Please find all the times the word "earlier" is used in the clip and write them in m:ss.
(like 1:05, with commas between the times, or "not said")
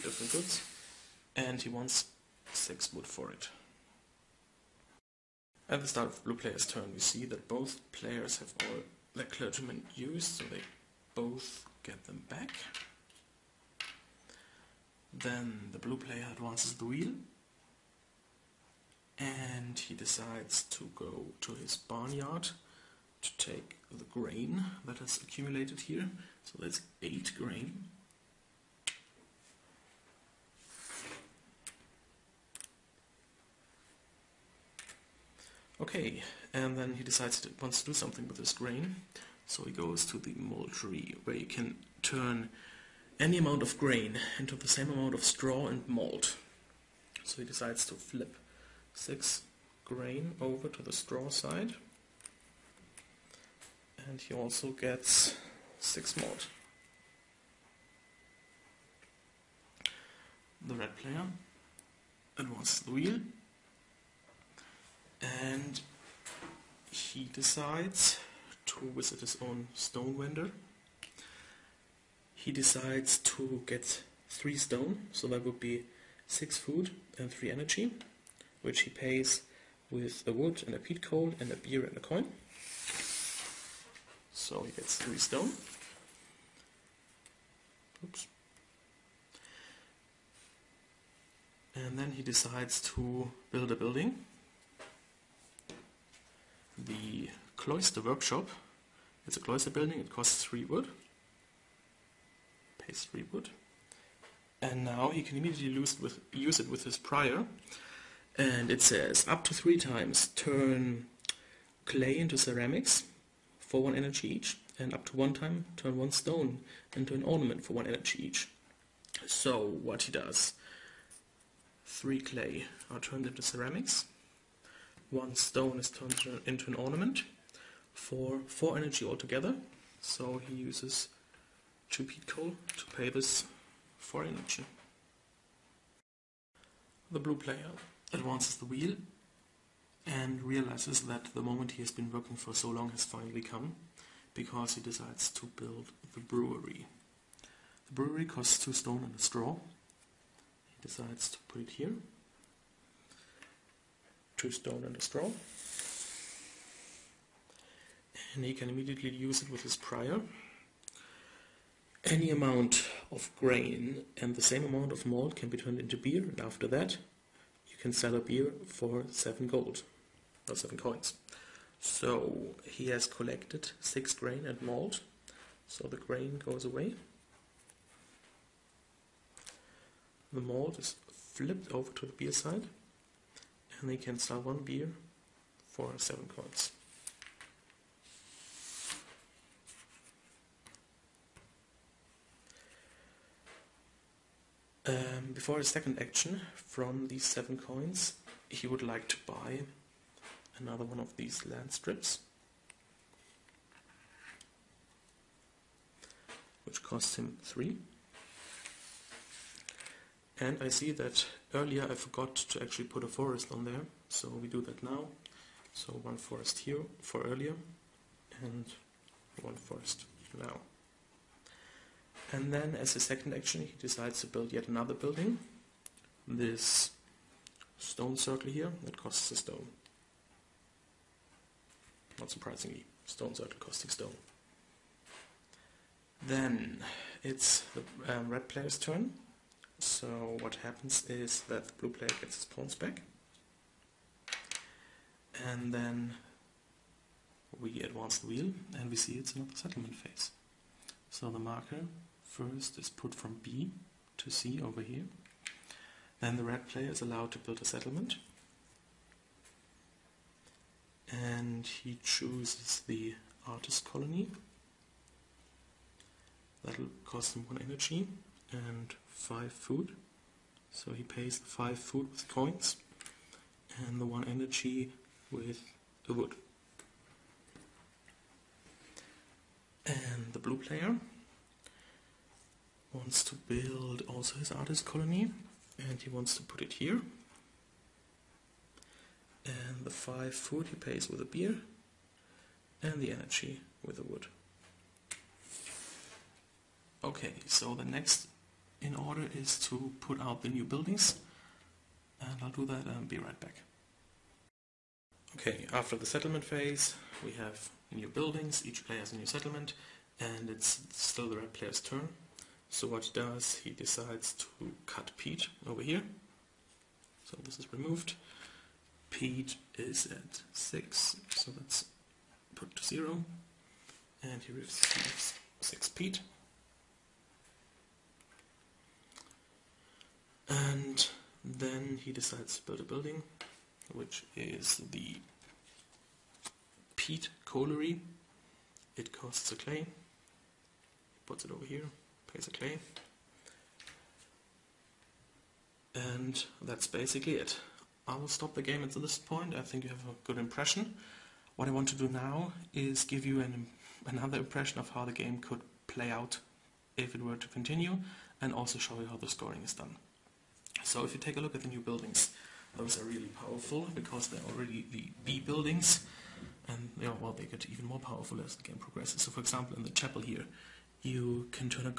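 3:31, 3:37.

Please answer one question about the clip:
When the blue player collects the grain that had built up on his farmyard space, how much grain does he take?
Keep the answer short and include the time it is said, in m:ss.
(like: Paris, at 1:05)
8, at 0:27.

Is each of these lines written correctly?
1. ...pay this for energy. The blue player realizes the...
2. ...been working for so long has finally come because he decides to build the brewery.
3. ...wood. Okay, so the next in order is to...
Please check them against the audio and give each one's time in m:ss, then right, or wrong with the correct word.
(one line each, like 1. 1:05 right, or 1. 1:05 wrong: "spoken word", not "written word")
1. 2:12 wrong: "advances", not "realizes"
2. 2:21 right
3. 4:54 right.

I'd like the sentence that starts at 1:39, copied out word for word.
It's a cloister building, it costs 3 wood.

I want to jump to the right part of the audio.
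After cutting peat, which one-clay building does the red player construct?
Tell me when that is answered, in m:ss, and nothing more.
5:36.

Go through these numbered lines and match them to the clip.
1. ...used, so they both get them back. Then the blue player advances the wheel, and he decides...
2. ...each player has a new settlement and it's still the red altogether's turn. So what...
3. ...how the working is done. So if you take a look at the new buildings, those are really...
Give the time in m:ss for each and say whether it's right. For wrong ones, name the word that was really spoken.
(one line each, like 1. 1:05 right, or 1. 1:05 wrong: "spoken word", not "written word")
1. 0:09 right
2. 5:08 wrong: "player", not "altogether"
3. 5:59 wrong: "scoring", not "working".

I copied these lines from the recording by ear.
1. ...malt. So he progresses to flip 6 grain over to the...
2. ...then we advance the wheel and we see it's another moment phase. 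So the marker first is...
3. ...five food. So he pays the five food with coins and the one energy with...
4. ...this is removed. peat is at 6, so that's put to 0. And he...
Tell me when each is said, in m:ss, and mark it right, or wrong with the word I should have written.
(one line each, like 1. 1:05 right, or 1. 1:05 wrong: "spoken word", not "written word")
1. 0:45 wrong: "decides", not "progresses"
2. 4:05 wrong: "settlement", not "moment"
3. 4:29 right
4. 5:17 right.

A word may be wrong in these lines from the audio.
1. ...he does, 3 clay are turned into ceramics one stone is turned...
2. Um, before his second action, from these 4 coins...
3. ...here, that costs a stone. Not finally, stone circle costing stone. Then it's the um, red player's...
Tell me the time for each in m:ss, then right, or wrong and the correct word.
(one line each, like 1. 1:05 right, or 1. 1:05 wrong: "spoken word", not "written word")
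1. 2:00 right
2. 3:14 wrong: "7", not "4"
3. 3:48 wrong: "surprisingly", not "finally".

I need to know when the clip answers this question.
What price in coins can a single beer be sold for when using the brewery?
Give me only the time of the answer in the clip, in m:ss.
2:50.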